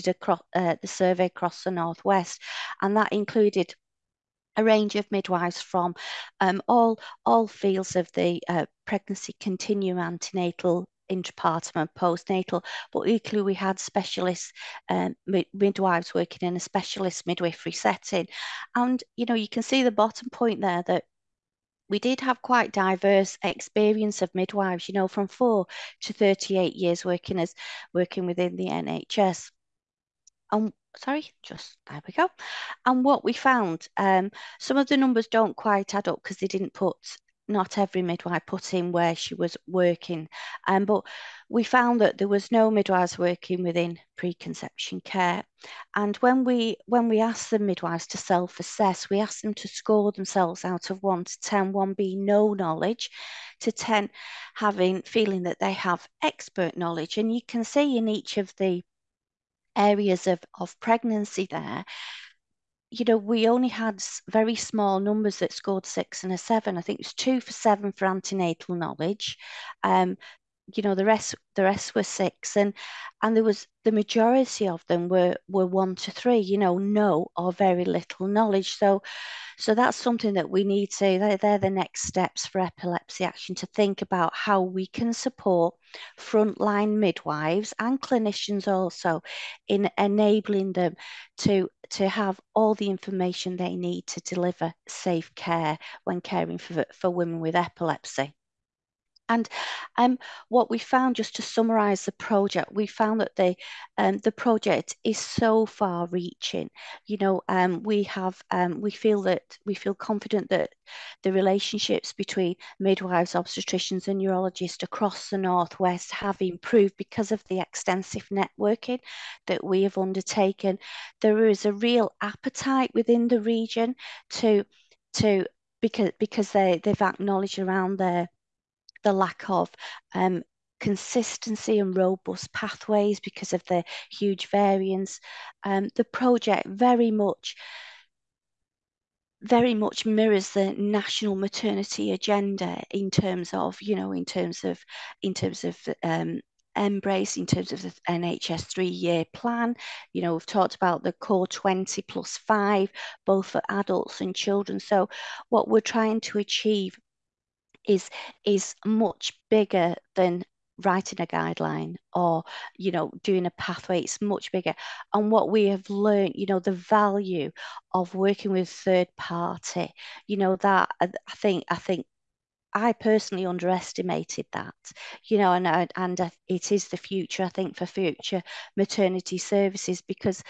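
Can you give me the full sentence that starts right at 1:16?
You know, no or very little knowledge.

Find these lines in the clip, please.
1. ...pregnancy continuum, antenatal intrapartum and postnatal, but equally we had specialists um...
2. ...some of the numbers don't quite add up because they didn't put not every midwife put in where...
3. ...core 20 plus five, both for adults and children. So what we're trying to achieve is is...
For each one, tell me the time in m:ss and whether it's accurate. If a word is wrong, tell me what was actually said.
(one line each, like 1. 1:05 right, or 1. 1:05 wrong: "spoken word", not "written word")
1. 0:08 right
2. 0:34 right
3. 2:31 right.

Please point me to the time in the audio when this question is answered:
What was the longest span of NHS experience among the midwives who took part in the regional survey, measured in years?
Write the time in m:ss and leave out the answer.
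0:26.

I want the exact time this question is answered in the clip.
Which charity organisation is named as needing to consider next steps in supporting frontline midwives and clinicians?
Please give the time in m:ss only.
1:22.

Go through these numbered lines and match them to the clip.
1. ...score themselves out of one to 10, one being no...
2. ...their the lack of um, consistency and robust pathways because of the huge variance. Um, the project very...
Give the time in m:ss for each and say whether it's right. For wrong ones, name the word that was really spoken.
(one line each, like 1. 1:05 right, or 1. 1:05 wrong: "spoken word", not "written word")
1. 0:49 right
2. 2:07 right.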